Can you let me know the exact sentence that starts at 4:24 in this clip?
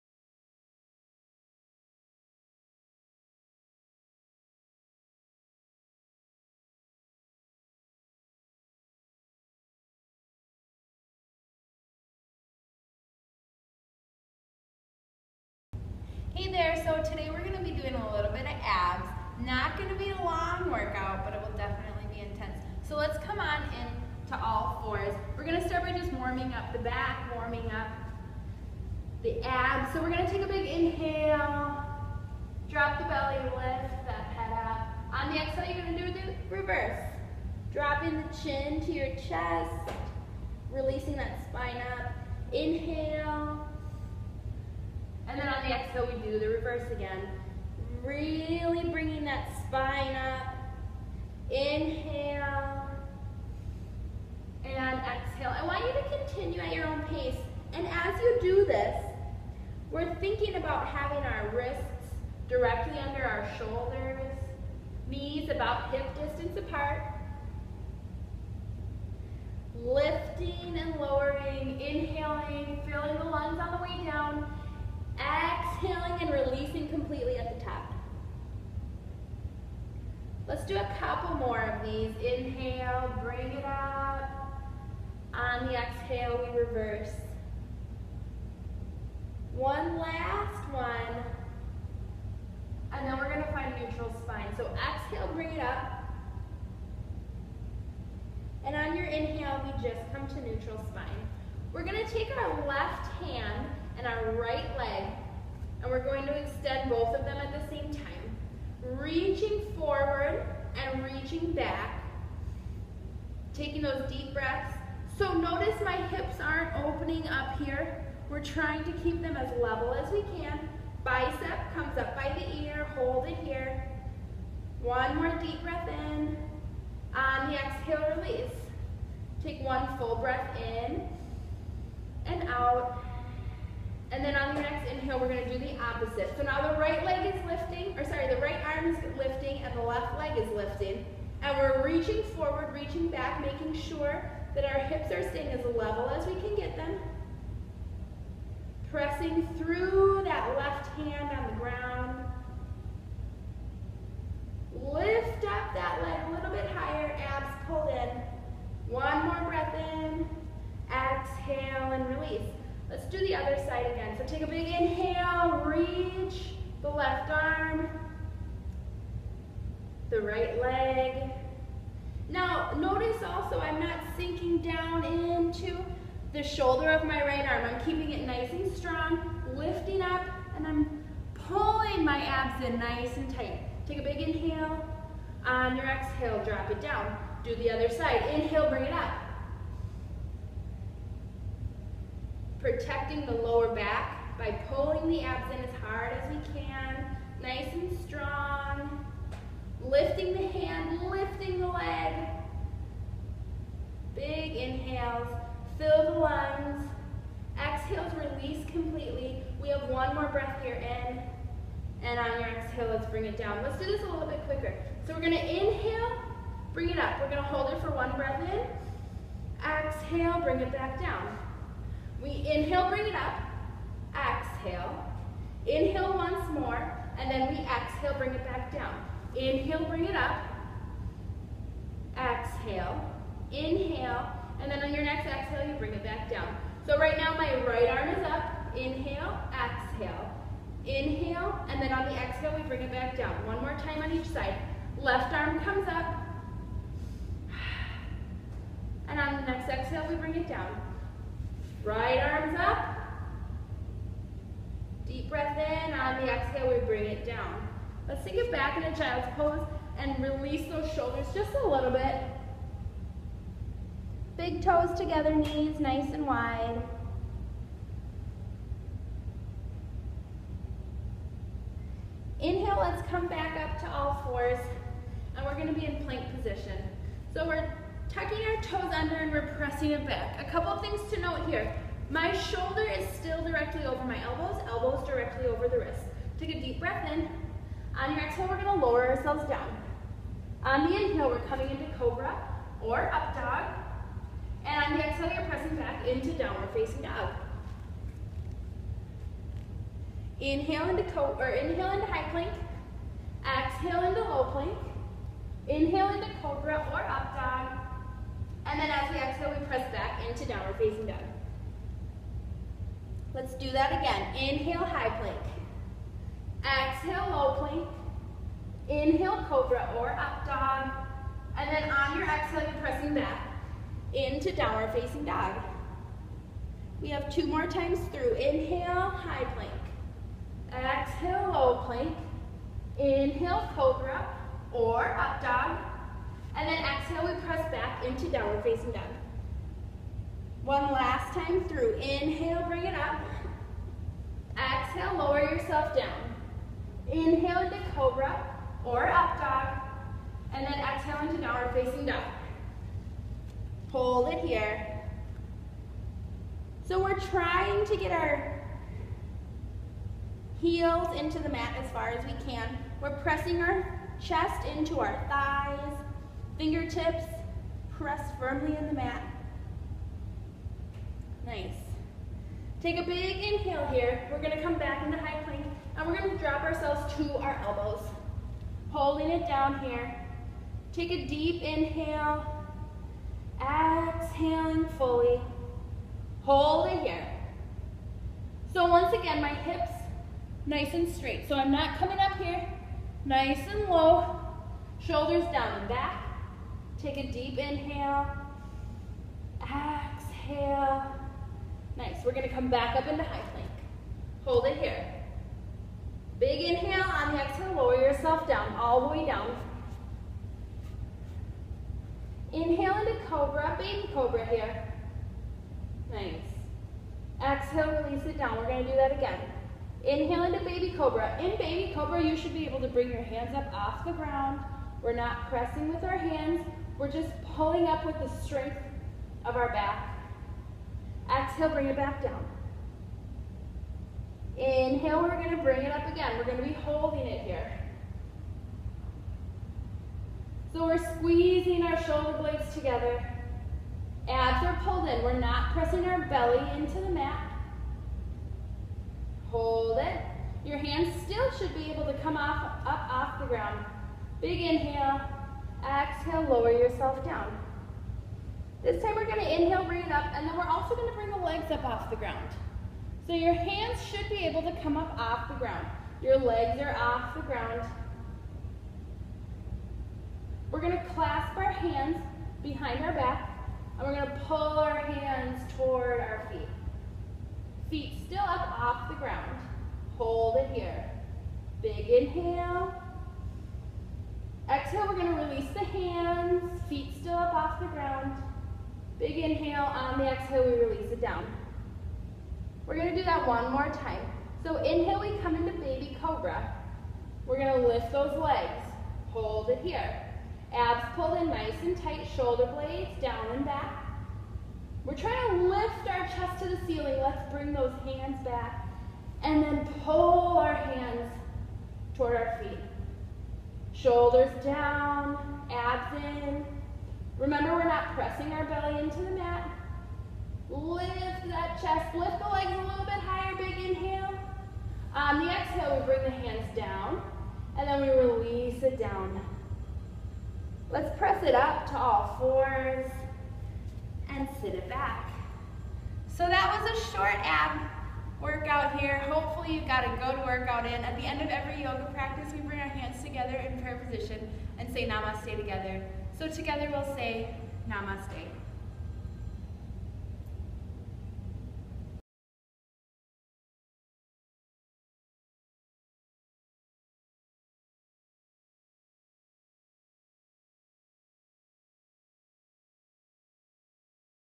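Big toes together, knees nice and wide.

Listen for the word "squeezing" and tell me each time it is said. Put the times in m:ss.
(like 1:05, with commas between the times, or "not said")
7:21.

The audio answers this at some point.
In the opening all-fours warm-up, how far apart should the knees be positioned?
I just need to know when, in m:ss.
1:05.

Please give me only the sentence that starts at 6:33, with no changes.
Nice and low, shoulders down and back.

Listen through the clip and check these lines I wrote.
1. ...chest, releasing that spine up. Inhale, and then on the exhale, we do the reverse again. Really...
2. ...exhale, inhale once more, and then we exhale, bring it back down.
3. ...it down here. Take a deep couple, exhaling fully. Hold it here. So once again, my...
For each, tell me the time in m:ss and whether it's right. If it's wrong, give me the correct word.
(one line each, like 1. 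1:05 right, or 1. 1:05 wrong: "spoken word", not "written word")
1. 0:39 right
2. 3:44 right
3. 6:19 wrong: "inhale", not "couple".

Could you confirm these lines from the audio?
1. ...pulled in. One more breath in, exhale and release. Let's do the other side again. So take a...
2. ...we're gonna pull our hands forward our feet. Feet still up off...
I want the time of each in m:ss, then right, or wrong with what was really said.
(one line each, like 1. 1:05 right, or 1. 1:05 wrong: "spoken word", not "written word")
1. 2:37 right
2. 7:54 wrong: "toward", not "forward".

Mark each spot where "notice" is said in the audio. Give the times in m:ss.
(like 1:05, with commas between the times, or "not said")
1:55, 2:52.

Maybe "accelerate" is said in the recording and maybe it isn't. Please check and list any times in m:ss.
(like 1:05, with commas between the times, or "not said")
not said.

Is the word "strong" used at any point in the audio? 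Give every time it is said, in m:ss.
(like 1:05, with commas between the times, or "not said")
2:58, 3:18.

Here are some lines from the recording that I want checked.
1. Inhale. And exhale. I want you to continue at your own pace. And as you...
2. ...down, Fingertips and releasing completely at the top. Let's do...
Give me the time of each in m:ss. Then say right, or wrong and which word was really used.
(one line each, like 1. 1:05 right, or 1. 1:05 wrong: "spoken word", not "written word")
1. 0:51 right
2. 1:14 wrong: "Exhaling", not "Fingertips".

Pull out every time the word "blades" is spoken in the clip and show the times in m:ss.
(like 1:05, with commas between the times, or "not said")
7:22, 8:22.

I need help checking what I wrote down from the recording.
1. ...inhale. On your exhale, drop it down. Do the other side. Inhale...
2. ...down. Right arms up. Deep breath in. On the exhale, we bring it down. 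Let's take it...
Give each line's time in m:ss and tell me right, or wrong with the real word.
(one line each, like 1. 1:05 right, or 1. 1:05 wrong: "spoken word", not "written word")
1. 3:04 right
2. 4:10 right.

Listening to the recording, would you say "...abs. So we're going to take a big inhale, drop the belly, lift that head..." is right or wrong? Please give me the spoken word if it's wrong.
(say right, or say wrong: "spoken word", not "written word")
right.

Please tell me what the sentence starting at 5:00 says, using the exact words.
Inhale into co or inhale into high plank.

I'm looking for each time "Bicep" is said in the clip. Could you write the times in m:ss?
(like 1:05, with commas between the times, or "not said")
2:01.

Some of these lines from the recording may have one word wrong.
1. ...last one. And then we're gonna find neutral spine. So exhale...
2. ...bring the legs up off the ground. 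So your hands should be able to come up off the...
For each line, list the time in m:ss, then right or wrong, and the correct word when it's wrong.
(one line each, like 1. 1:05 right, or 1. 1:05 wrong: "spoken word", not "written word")
1. 1:29 right
2. 7:41 right.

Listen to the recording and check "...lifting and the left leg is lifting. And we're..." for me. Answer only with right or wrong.
right.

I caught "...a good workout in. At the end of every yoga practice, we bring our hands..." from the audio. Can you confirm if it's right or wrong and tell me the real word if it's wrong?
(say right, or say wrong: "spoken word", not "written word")
right.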